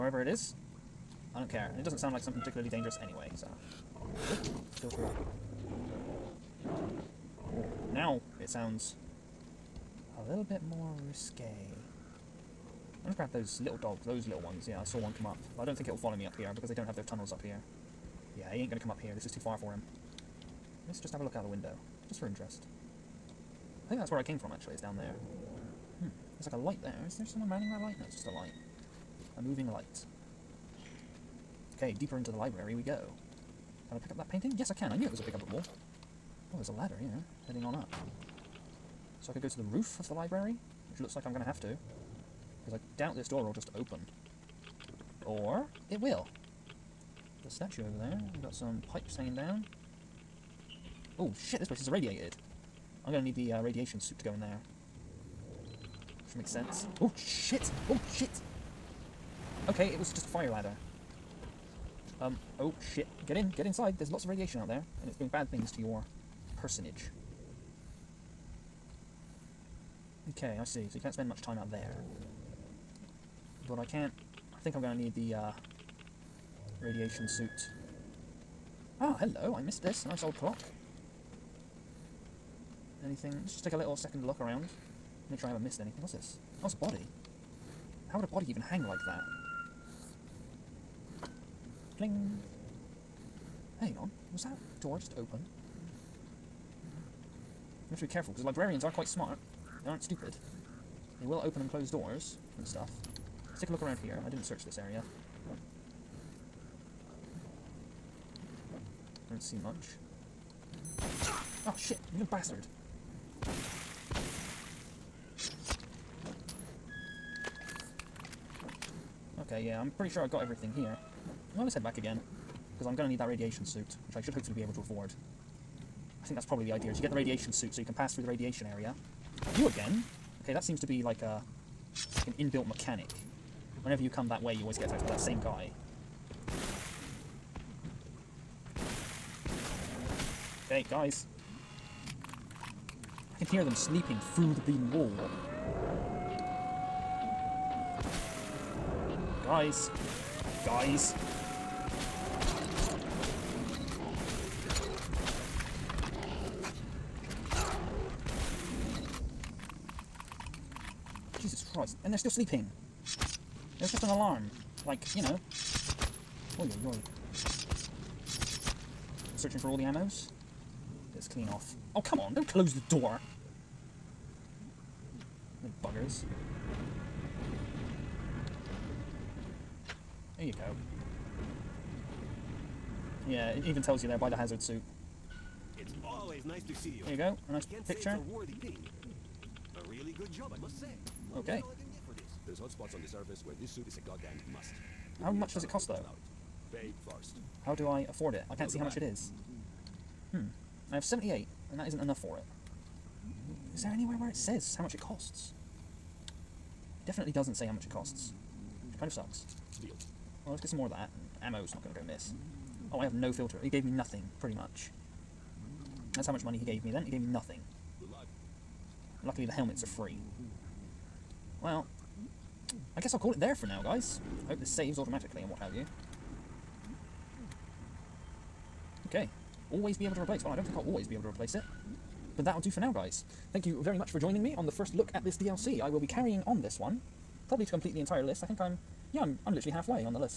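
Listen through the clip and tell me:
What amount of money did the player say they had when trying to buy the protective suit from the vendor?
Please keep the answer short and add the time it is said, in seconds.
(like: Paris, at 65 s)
78, at 201 s.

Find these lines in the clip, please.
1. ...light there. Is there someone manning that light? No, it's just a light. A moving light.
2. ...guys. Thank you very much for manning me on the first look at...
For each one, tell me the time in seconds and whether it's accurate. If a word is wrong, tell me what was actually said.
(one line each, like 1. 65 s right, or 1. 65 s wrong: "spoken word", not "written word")
1. 26 s right
2. 232 s wrong: "joining", not "manning".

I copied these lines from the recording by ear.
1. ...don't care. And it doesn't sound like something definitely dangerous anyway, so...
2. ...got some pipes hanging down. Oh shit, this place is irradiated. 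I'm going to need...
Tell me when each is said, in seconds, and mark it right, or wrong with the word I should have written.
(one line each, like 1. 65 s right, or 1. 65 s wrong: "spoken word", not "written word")
1. 1 s wrong: "particularly", not "definitely"
2. 48 s right.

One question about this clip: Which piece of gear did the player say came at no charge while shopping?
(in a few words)
Helmets.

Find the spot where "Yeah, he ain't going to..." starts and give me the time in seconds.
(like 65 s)
18 s.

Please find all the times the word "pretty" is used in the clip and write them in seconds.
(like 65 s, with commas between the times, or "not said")
119 s, 214 s.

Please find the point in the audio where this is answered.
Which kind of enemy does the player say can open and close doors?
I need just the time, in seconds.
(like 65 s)
98 s.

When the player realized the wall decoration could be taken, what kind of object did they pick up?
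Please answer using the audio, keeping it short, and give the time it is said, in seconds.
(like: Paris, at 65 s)
Painting, at 34 s.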